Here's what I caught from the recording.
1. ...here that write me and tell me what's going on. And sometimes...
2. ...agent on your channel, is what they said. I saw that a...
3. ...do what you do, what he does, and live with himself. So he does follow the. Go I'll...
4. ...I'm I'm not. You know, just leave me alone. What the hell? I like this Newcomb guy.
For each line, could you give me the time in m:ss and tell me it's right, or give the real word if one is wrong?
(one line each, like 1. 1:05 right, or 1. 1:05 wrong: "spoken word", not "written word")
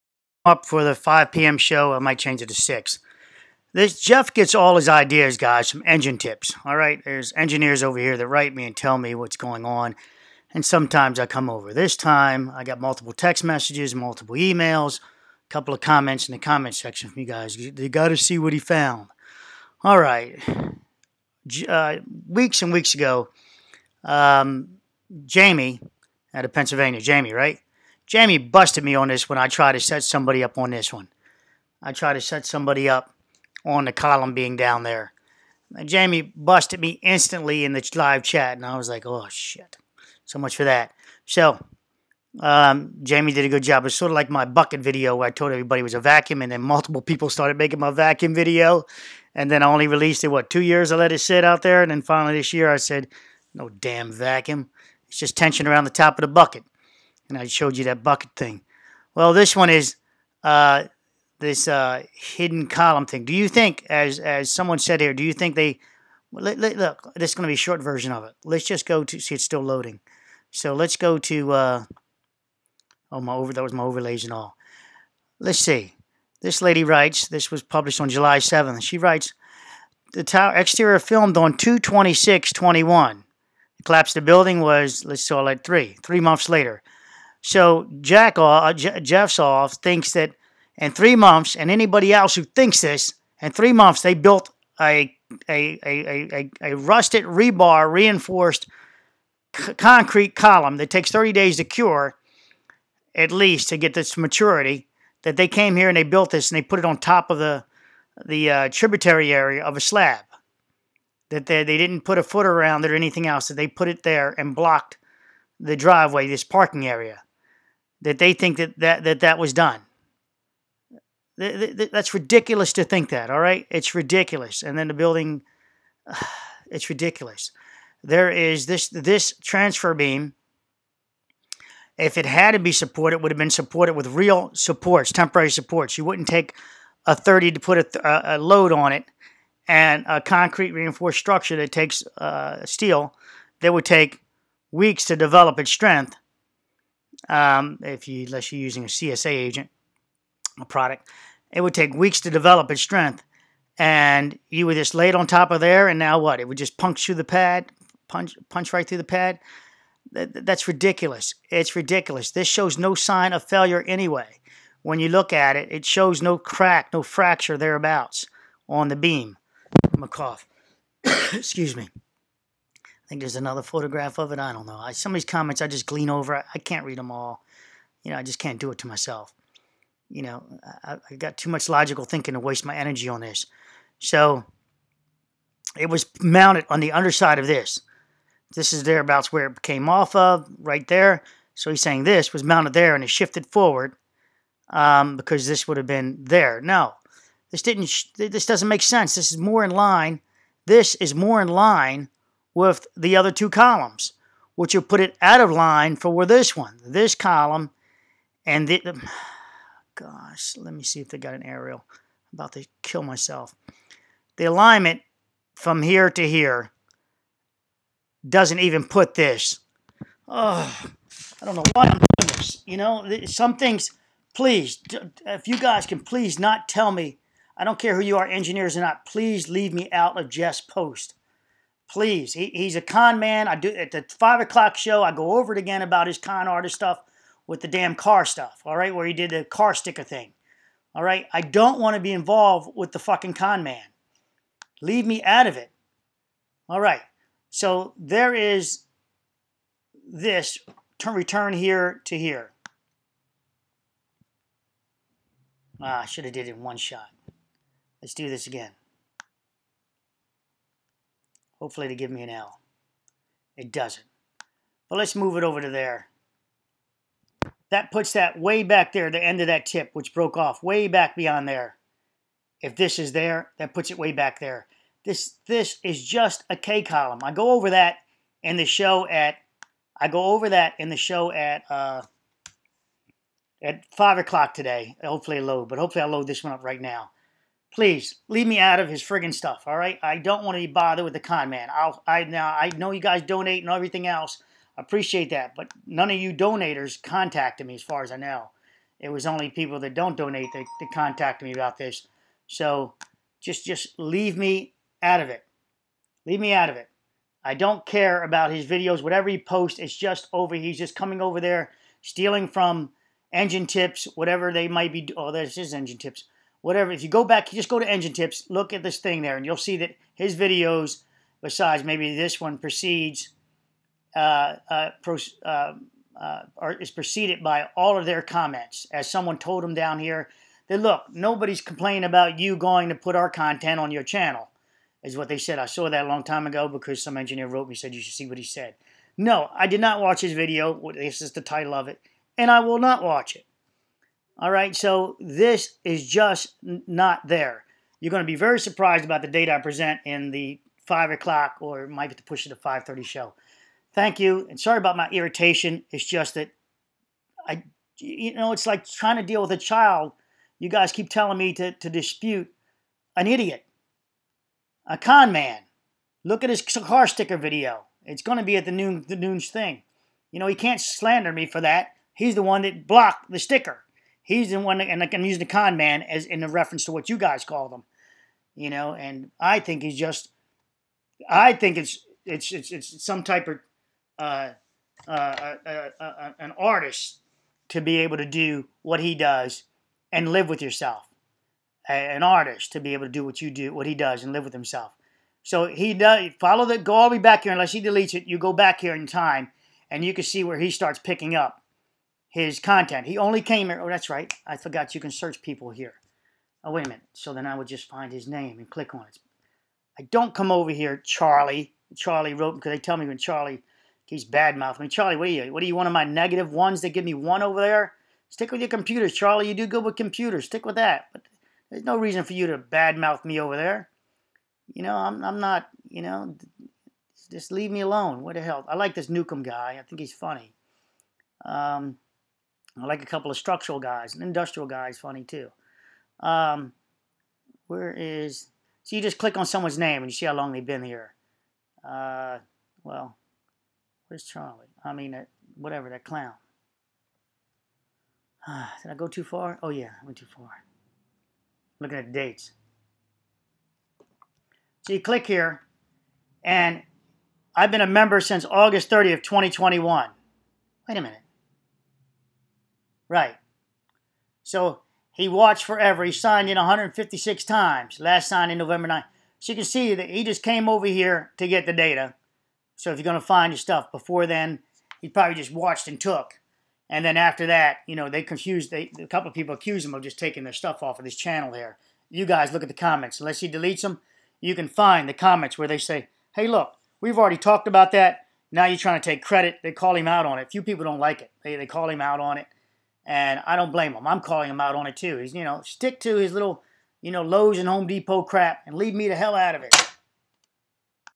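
1. 0:07 right
2. 5:33 wrong: "content", not "agent"
3. 6:33 right
4. 7:04 right.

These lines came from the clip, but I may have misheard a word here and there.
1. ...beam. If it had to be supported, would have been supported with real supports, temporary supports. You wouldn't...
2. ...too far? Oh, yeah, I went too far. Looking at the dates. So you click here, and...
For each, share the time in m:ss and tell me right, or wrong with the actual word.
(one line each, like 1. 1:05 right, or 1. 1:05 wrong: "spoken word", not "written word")
1. 2:09 right
2. 7:29 right.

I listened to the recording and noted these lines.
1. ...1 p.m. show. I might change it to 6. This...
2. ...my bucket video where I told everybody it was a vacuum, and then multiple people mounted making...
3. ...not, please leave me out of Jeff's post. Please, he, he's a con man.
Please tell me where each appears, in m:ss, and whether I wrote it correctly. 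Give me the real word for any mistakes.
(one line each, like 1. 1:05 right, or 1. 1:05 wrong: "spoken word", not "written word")
1. 0:00 wrong: "5", not "1"
2. 0:44 wrong: "started", not "mounted"
3. 3:48 right.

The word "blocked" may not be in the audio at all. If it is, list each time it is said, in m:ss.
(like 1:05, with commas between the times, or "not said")
1:54, 6:12.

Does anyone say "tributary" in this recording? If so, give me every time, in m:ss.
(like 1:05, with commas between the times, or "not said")
1:48.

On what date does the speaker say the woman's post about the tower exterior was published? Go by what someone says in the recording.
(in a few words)
July 7.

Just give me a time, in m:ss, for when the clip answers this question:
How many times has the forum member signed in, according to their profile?
7:46.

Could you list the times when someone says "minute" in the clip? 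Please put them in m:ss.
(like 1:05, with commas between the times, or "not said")
6:46, 7:41.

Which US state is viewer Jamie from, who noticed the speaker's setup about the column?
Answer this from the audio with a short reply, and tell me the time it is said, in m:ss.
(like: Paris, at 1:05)
Pennsylvania, at 0:26.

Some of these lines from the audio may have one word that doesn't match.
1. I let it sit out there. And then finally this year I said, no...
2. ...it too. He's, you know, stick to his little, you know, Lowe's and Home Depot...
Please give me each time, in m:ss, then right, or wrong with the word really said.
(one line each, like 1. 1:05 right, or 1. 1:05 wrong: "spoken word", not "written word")
1. 0:50 right
2. 8:14 right.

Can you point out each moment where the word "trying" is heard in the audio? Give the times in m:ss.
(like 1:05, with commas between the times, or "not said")
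5:58, 8:08.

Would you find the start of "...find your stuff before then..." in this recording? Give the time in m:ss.
7:53.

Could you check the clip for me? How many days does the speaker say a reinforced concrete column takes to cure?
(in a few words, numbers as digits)
30 days.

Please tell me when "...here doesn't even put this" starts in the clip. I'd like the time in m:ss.
3:36.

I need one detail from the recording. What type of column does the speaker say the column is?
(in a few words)
K column.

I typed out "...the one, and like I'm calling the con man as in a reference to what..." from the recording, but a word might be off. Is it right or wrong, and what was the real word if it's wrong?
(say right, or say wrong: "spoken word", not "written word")
wrong: "using", not "calling".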